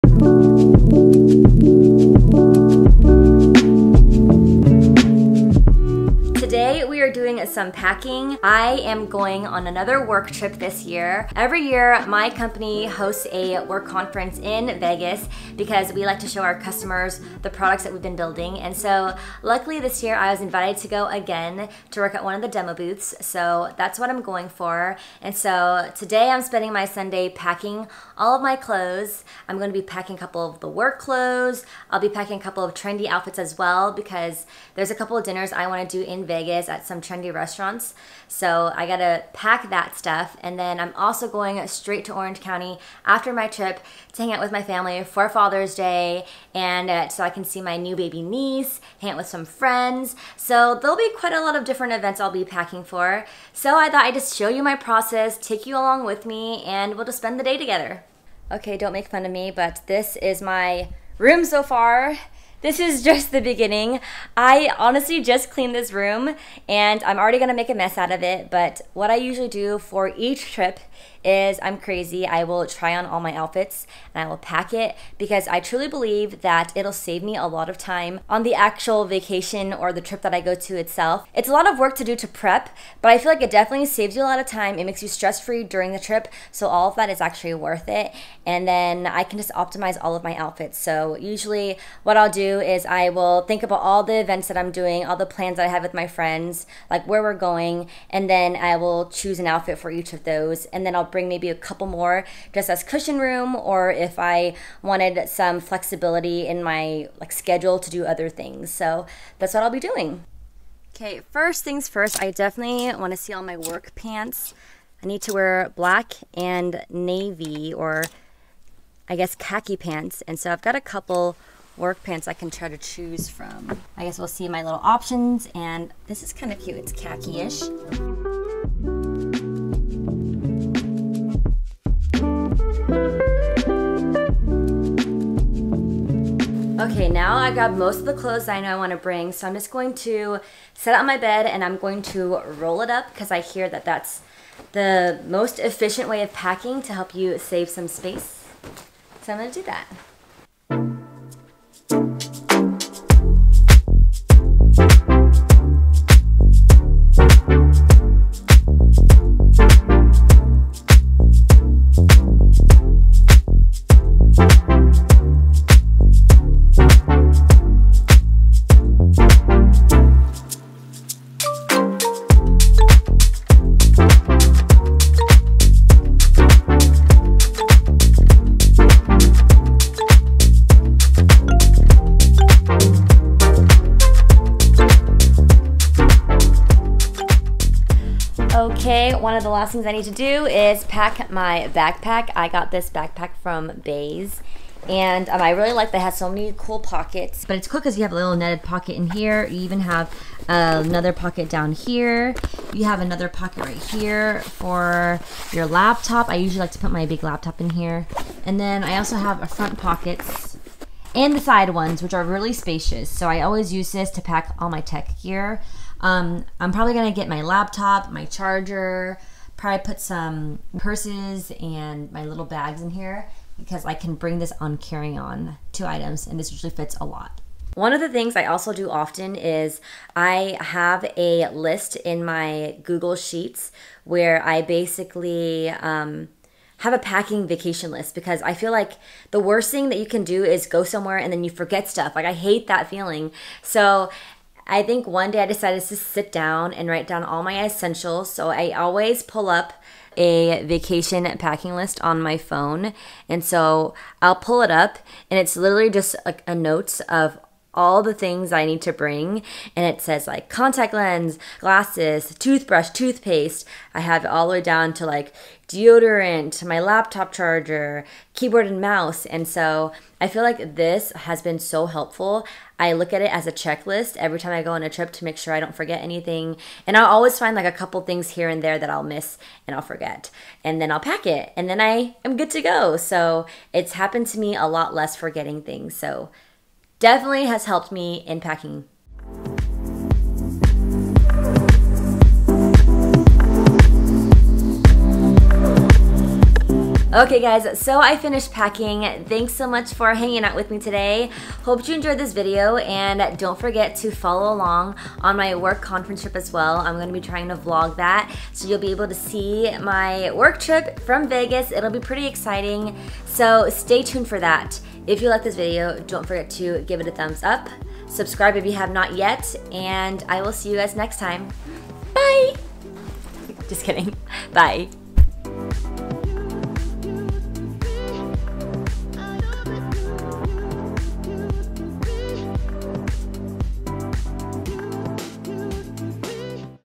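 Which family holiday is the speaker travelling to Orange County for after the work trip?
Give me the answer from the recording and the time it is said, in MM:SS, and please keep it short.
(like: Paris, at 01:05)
Father's Day, at 00:45.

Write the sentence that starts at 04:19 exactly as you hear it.
And it says like contact lens, glasses, toothbrush, toothpaste.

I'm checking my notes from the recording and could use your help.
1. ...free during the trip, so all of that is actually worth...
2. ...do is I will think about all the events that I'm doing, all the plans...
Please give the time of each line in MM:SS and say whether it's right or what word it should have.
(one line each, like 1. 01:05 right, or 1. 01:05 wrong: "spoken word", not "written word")
1. 01:25 right
2. 01:32 right.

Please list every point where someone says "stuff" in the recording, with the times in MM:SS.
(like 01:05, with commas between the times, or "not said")
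00:39, 04:01.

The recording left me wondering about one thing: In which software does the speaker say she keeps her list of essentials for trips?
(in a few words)
Google Sheets.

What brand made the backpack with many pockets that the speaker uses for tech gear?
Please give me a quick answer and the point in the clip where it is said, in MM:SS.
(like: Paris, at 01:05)
Béis, at 03:13.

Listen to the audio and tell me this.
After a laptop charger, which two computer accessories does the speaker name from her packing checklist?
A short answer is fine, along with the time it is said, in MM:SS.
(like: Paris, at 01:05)
keyboard and mouse, at 04:28.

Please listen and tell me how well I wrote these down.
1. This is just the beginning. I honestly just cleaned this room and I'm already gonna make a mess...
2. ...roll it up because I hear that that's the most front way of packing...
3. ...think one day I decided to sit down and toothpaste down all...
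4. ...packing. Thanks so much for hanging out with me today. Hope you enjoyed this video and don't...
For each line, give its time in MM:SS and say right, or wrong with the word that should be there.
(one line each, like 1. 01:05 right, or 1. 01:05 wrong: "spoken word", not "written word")
1. 01:02 right
2. 02:22 wrong: "efficient", not "front"
3. 04:04 wrong: "write", not "toothpaste"
4. 04:58 right.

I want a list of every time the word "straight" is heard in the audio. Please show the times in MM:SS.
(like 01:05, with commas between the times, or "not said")
00:41.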